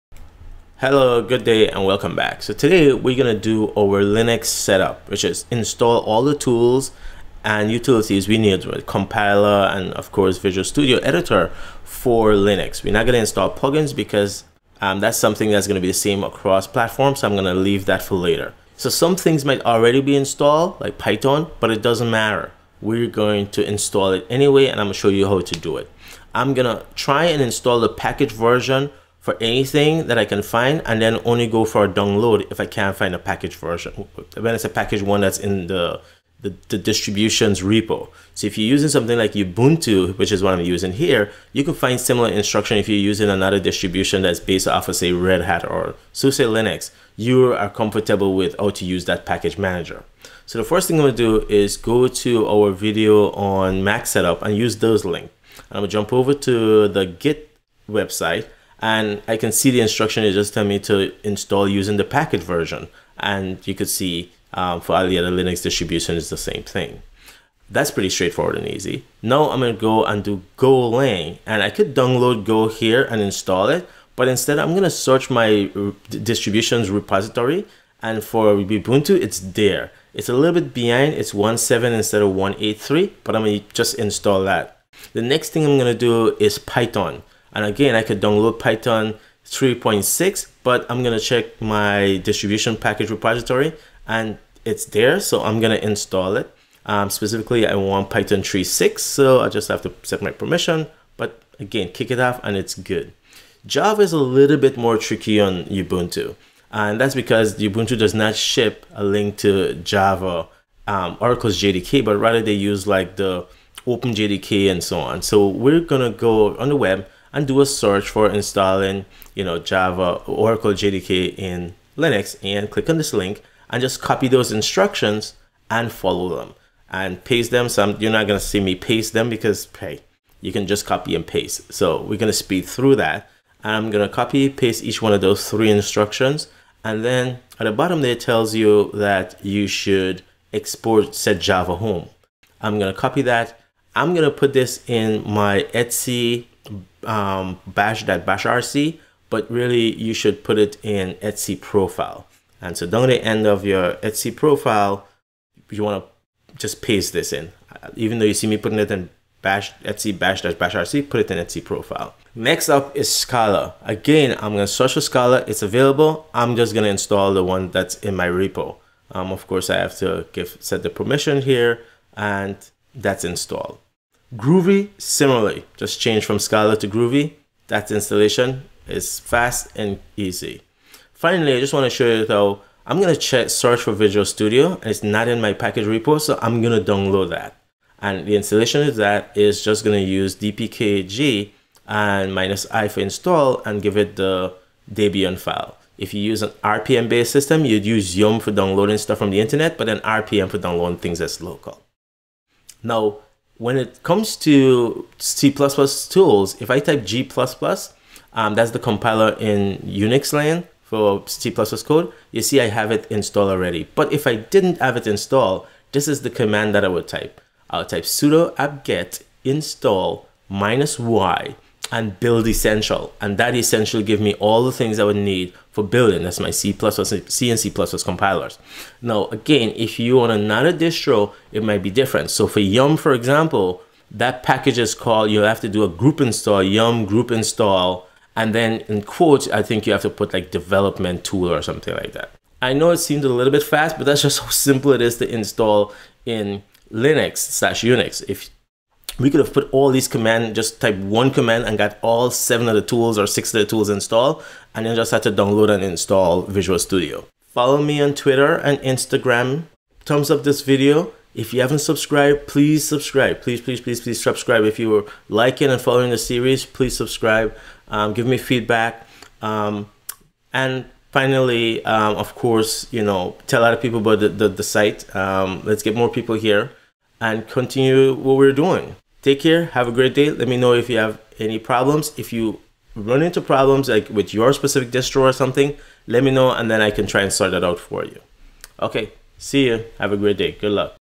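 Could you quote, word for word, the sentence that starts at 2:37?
Even though you see me putting it in bash Etsy bash dash bash RC, put it in Etsy profile.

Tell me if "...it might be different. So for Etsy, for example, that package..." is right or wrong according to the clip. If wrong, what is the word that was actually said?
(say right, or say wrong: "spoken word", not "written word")
wrong: "Yum", not "Etsy".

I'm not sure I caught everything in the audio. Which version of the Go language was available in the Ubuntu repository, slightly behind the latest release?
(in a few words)
1.7.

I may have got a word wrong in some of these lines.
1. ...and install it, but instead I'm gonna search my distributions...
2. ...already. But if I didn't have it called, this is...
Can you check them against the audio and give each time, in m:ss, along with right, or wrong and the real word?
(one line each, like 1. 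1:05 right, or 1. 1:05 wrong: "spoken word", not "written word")
1. 1:13 right
2. 3:33 wrong: "installed", not "called".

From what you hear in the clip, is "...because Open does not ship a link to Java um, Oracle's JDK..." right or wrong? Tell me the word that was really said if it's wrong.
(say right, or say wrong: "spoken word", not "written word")
wrong: "Ubuntu", not "Open".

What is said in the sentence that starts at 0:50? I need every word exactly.
So the first thing I'm gonna do is go to our video on Mac setup and use those link.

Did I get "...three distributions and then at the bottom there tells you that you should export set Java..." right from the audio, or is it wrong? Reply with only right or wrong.
wrong.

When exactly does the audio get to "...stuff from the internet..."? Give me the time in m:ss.
3:18.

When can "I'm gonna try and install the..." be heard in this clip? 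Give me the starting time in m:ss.
0:26.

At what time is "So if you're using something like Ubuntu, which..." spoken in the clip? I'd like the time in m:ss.
0:38.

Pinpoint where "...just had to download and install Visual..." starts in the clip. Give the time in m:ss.
4:14.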